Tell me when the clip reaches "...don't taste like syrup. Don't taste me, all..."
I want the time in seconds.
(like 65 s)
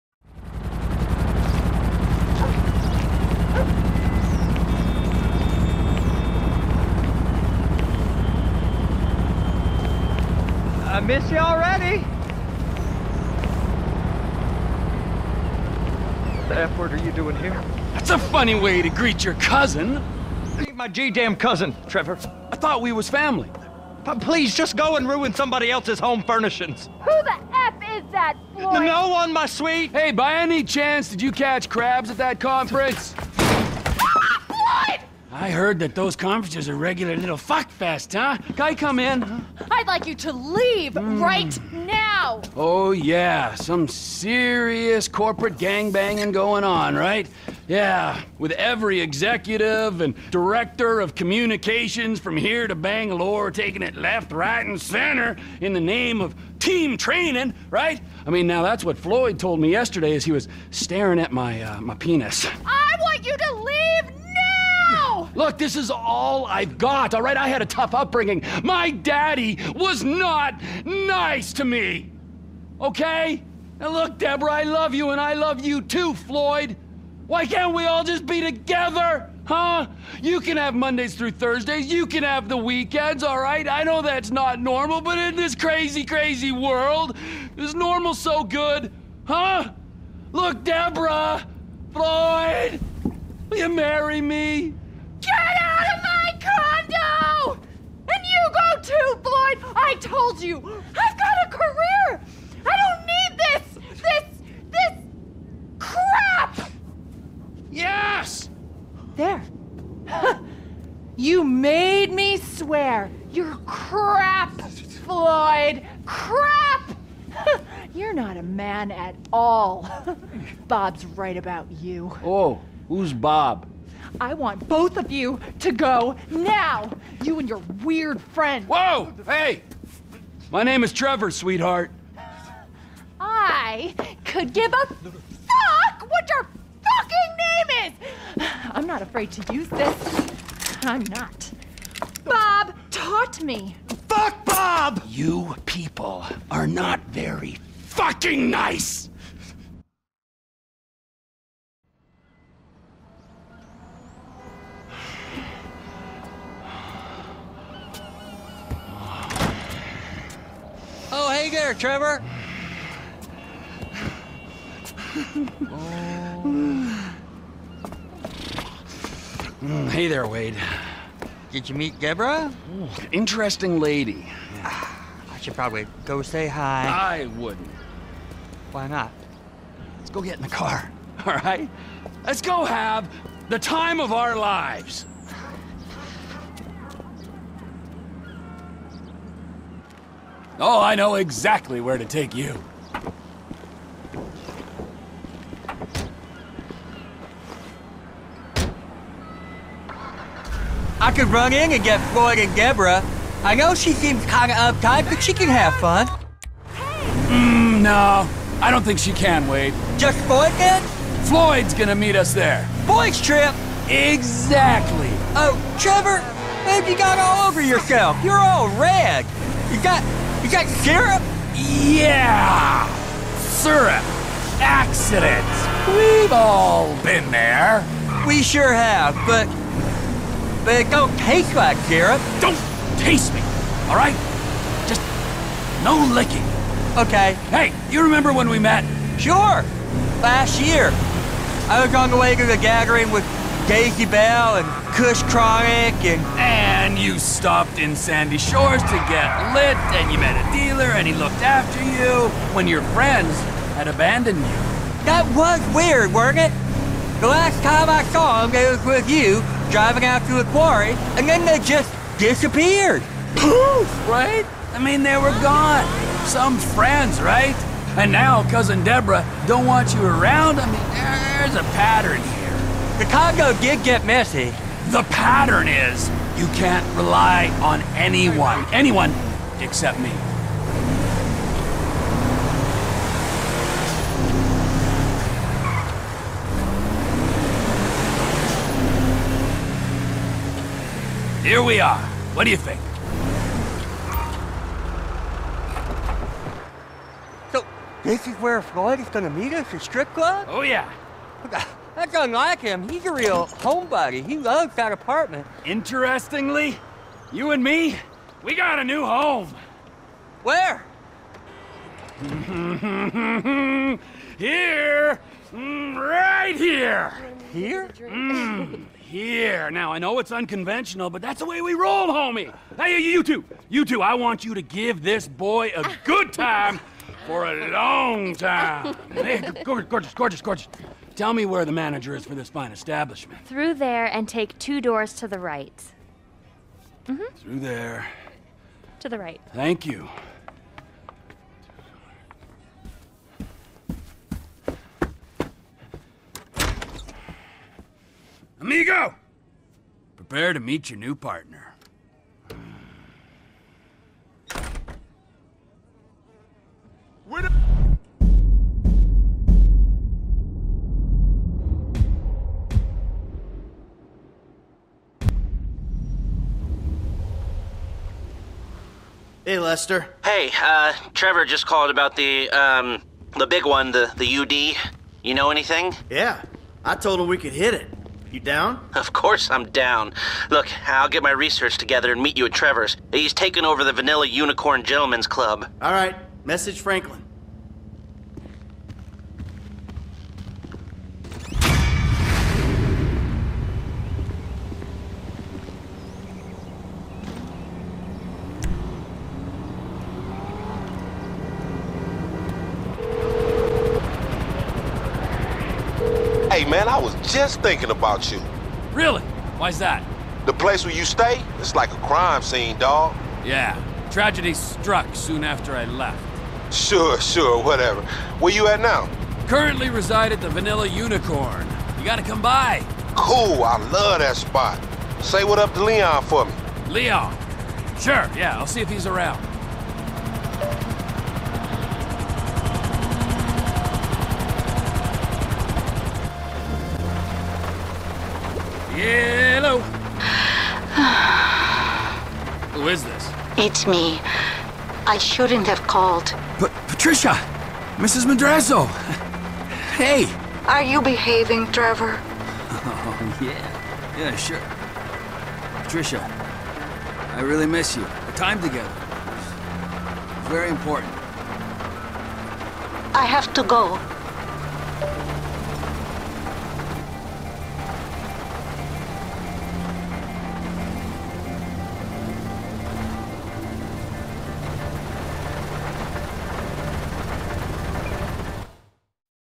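230 s.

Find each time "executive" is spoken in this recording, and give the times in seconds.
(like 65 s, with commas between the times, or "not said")
48 s.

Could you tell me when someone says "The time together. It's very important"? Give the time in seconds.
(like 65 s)
458 s.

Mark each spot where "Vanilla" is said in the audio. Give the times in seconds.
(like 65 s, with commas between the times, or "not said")
383 s, 420 s.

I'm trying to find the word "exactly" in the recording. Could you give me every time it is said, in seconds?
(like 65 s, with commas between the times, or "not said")
191 s, 213 s.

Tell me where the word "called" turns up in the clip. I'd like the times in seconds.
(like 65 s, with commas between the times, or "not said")
371 s, 445 s.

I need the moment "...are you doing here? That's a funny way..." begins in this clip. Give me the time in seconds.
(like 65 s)
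16 s.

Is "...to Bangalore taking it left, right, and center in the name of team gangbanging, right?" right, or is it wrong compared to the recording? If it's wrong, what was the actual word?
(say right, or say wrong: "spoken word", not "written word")
wrong: "training", not "gangbanging".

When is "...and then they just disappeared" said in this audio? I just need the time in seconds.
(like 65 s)
261 s.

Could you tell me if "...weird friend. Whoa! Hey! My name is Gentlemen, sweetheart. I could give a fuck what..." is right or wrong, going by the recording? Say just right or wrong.
wrong.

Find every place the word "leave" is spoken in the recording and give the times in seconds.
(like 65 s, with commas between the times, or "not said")
40 s, 63 s.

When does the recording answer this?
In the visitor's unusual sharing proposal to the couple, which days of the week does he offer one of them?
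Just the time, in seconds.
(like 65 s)
80 s.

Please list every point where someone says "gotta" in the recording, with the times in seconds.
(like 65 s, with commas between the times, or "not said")
422 s.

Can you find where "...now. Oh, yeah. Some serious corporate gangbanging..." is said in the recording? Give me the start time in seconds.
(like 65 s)
41 s.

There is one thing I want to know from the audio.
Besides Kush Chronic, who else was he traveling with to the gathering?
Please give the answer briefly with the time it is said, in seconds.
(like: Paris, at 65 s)
Daisy Bell, at 243 s.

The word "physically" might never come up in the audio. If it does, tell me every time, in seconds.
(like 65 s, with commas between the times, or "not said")
not said.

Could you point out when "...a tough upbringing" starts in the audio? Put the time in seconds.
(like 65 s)
67 s.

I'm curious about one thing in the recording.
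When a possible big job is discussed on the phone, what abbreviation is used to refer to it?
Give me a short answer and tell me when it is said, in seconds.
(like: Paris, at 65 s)
UD, at 374 s.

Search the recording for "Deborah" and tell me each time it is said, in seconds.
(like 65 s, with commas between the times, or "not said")
74 s, 90 s, 171 s, 202 s, 268 s.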